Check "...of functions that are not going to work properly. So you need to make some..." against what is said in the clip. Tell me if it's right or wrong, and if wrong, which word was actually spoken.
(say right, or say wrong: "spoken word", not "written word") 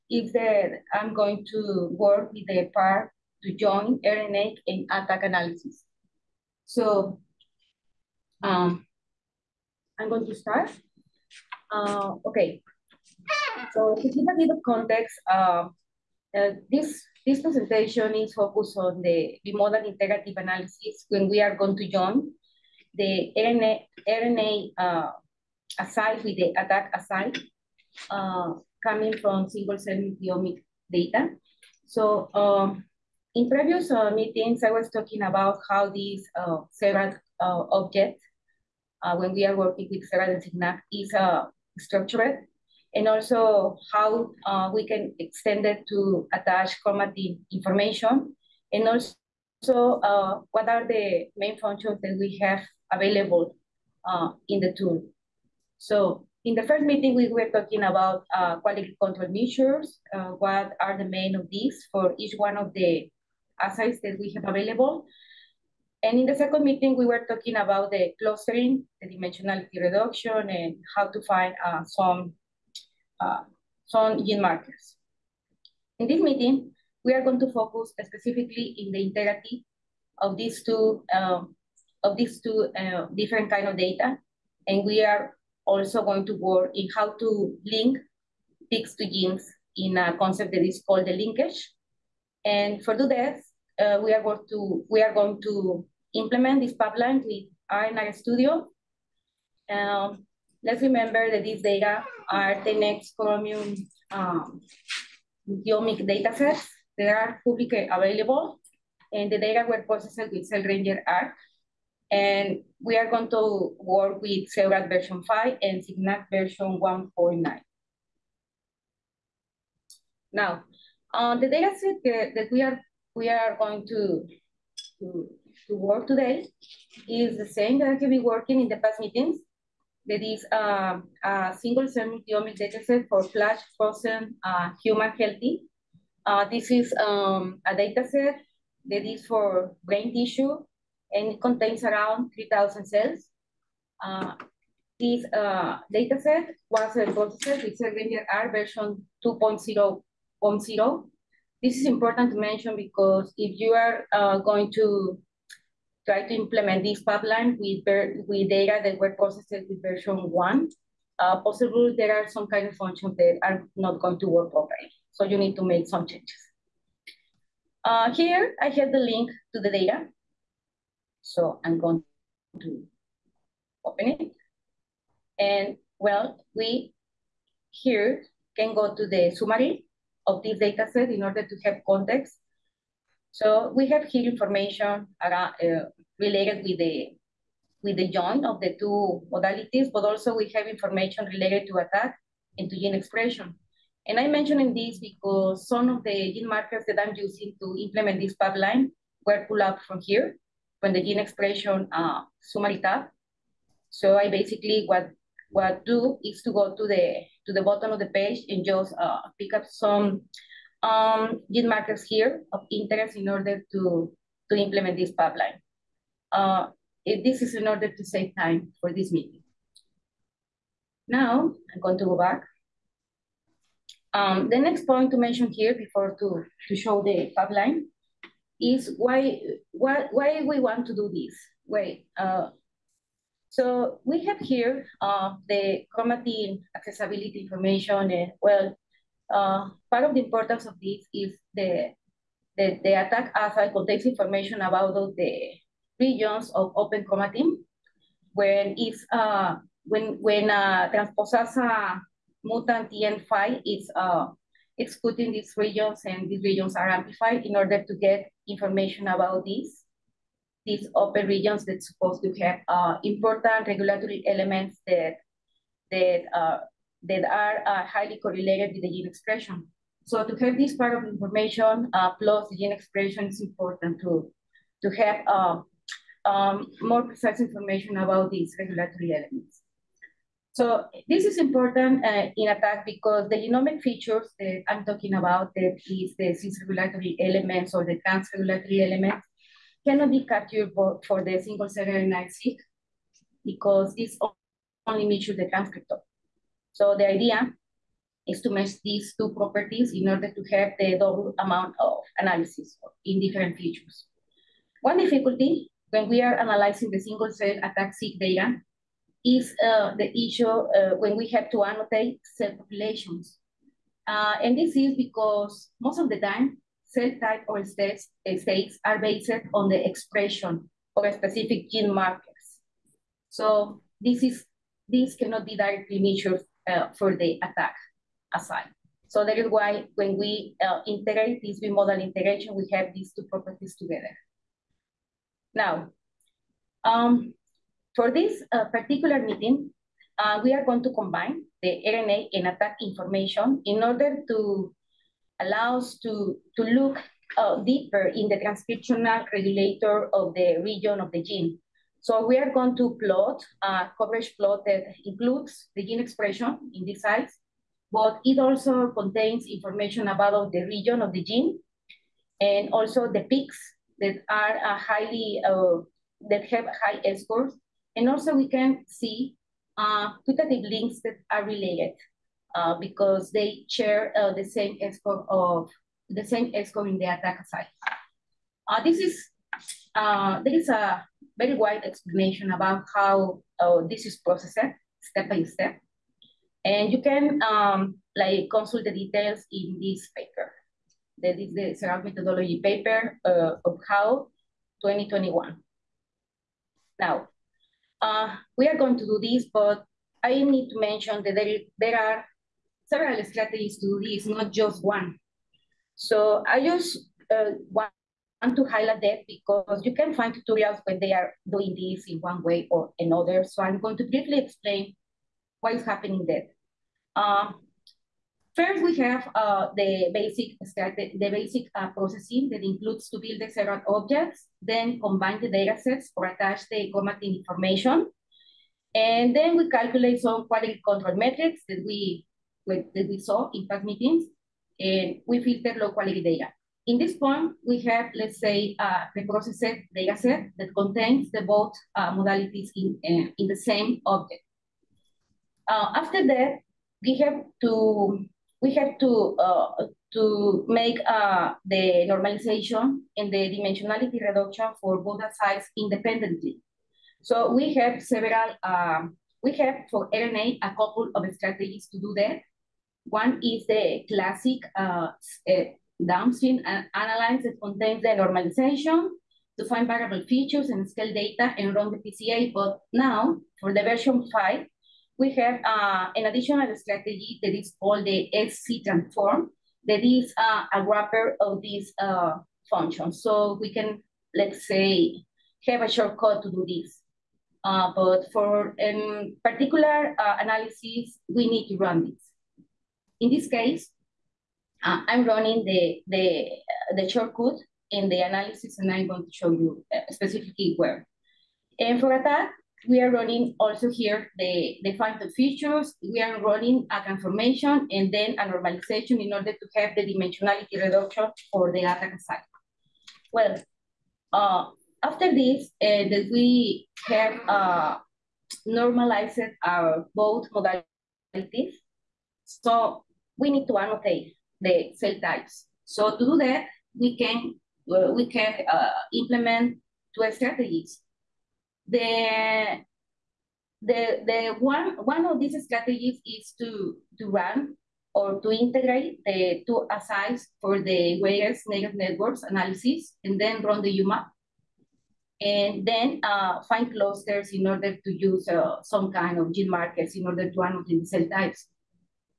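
right.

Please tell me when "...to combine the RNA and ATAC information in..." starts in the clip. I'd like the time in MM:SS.
05:40.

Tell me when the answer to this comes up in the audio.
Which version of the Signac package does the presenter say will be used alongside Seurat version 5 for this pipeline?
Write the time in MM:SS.
01:56.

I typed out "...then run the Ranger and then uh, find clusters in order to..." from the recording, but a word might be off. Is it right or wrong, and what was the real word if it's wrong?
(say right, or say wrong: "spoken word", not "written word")
wrong: "UMAP", not "Ranger".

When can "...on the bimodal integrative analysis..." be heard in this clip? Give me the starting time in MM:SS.
00:18.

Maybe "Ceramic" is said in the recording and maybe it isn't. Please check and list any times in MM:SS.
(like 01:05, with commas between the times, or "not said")
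06:31.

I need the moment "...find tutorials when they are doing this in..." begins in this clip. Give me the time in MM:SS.
06:50.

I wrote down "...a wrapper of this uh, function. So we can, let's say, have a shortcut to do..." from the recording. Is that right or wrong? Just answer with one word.
right.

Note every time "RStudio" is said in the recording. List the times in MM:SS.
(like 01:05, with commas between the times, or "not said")
01:37.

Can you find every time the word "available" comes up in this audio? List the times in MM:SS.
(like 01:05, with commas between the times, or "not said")
00:52, 01:04, 01:47.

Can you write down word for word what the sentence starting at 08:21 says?
And for that, we are running also here the, the factor features.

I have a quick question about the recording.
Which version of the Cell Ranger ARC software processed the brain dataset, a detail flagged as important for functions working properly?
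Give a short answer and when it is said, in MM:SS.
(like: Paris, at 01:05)
2.0.0, at 02:28.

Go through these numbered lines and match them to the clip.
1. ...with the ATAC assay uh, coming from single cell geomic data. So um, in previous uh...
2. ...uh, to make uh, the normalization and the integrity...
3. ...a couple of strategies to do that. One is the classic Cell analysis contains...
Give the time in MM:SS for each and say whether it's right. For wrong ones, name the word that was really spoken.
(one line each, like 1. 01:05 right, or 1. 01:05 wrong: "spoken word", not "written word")
1. 00:26 wrong: "multiomic", not "geomic"
2. 07:29 wrong: "dimensionality", not "integrity"
3. 07:40 wrong: "Downstream", not "Cell".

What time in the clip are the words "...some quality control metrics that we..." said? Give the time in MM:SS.
07:10.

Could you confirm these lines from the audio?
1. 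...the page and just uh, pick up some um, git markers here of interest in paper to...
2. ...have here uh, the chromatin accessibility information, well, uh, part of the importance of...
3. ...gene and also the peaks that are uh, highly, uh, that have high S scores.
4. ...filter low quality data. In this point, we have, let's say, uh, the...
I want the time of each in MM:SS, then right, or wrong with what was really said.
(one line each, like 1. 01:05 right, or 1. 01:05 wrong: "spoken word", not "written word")
1. 03:27 wrong: "order", not "paper"
2. 03:54 right
3. 06:01 right
4. 07:15 right.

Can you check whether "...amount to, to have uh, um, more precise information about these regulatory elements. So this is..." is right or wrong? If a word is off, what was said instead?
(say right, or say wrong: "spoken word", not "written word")
wrong: "important", not "amount".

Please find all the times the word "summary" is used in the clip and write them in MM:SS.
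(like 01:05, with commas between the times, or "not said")
02:59, 03:22.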